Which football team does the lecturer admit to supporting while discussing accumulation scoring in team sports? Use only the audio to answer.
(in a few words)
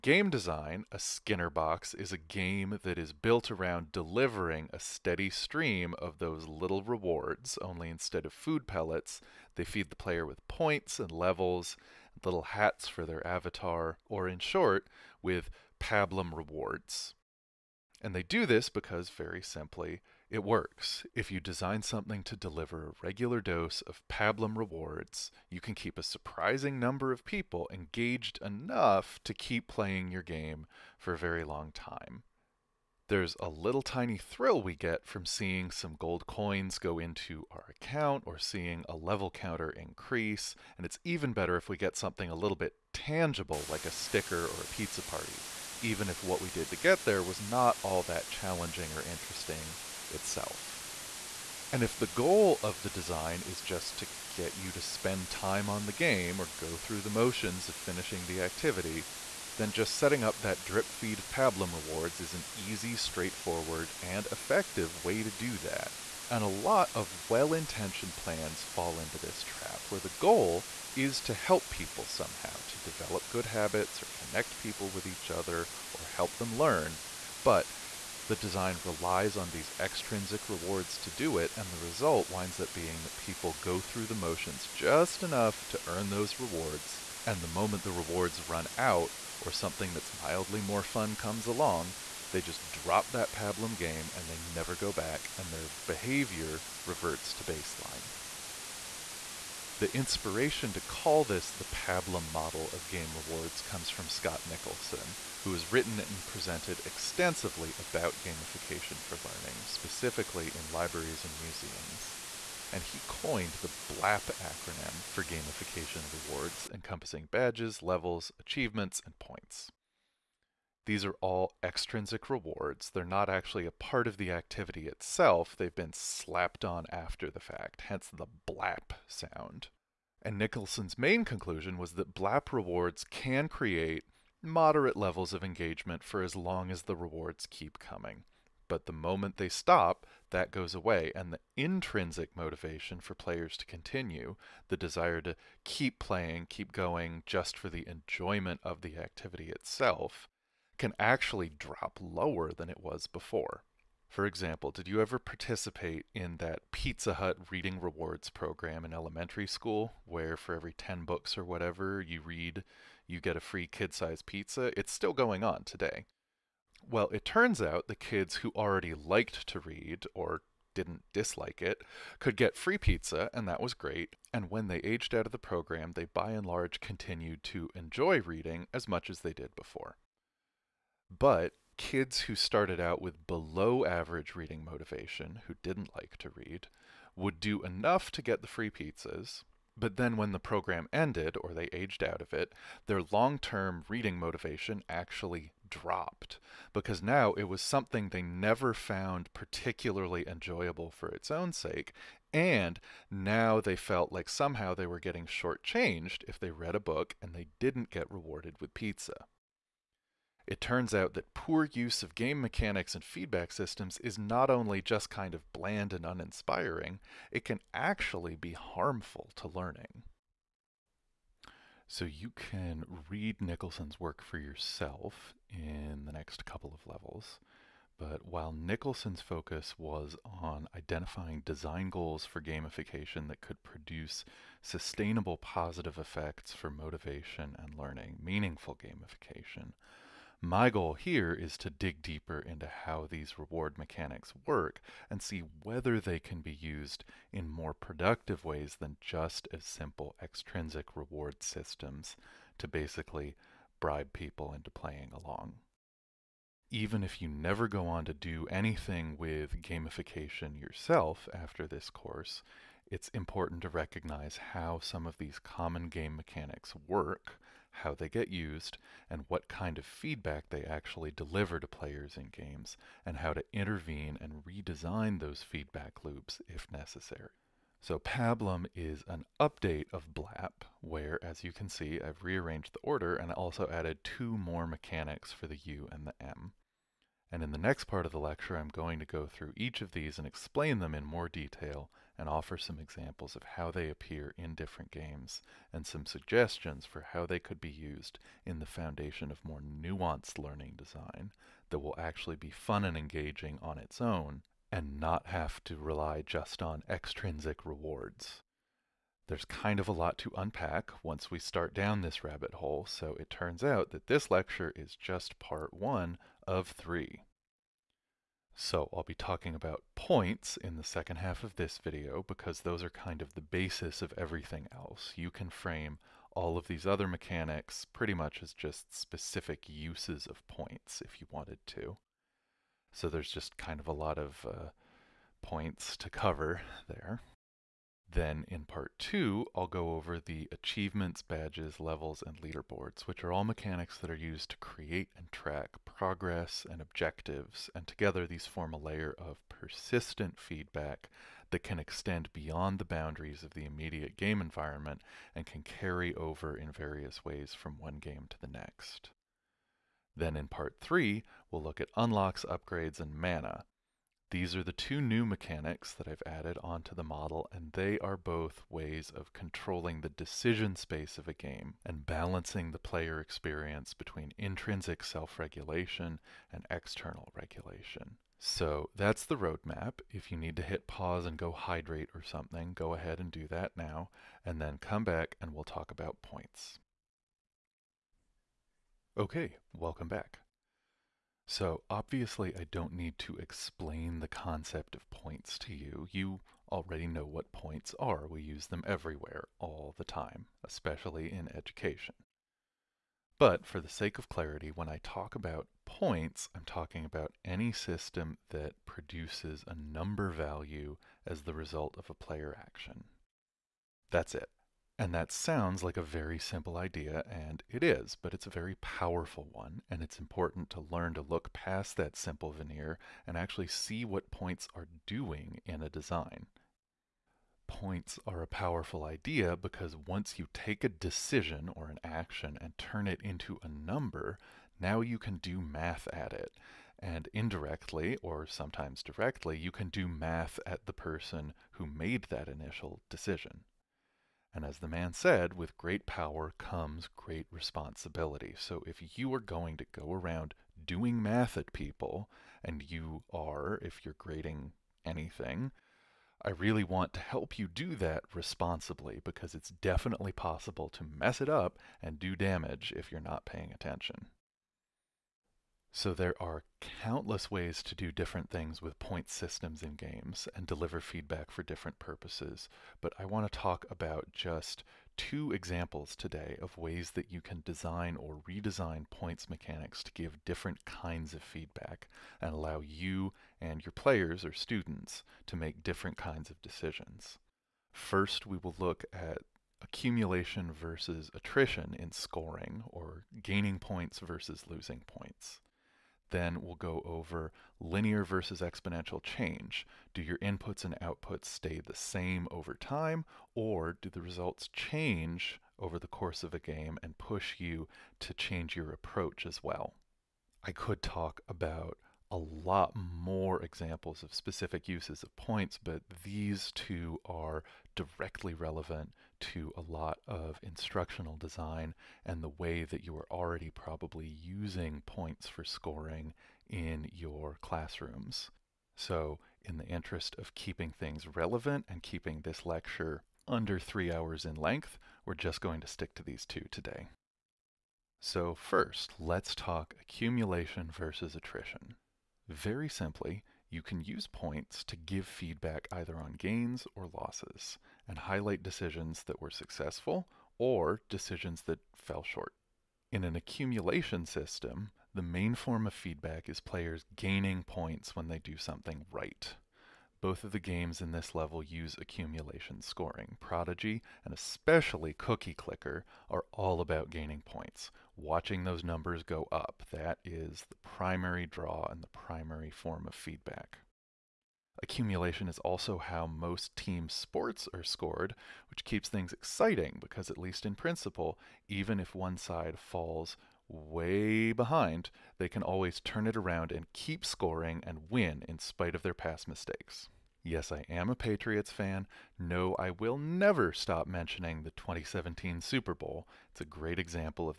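Patriots.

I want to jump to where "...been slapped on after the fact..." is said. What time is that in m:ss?
2:05.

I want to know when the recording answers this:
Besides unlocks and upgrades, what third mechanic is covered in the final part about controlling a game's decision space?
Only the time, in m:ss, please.
6:03.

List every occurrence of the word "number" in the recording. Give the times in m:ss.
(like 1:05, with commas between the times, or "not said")
0:26, 6:49, 7:13, 9:28.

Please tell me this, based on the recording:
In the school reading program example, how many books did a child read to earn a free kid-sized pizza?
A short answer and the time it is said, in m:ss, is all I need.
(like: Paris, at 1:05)
10, at 2:40.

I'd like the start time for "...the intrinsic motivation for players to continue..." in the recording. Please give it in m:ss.
2:21.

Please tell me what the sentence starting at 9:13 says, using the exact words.
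In an accumulation system, the main form of feedback is players gaining points when they do something right.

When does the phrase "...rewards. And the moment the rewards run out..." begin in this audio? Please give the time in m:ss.
1:26.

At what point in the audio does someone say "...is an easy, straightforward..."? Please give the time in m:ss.
1:02.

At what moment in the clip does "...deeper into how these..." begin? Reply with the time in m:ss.
4:02.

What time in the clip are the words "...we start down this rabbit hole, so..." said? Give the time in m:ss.
5:11.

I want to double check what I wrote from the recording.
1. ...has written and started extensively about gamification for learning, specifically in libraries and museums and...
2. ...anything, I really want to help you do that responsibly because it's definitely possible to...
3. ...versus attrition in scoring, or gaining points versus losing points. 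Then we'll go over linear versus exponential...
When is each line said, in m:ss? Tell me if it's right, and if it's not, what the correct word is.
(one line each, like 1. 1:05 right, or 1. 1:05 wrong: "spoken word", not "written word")
1. 1:45 wrong: "presented", not "started"
2. 7:35 right
3. 8:10 right.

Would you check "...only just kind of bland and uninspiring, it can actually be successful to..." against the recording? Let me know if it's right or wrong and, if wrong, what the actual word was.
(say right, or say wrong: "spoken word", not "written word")
wrong: "harmful", not "successful".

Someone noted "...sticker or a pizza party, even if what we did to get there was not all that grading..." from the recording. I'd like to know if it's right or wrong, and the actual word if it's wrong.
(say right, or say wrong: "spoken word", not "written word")
wrong: "challenging", not "grading".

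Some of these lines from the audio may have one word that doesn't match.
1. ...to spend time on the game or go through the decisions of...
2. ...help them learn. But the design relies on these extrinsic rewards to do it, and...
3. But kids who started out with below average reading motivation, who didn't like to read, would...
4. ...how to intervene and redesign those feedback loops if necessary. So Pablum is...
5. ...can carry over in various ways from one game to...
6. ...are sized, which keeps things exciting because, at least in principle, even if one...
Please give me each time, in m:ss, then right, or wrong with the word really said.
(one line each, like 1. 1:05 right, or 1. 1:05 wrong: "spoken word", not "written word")
1. 0:54 wrong: "motions", not "decisions"
2. 1:16 right
3. 3:01 right
4. 4:33 right
5. 5:55 right
6. 9:37 wrong: "scored", not "sized".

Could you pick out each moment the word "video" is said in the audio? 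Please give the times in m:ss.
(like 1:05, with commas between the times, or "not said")
5:21.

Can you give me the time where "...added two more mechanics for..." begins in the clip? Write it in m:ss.
4:43.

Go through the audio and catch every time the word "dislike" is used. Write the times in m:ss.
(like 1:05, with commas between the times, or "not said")
2:51.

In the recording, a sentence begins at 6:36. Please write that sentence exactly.
You already know what points are.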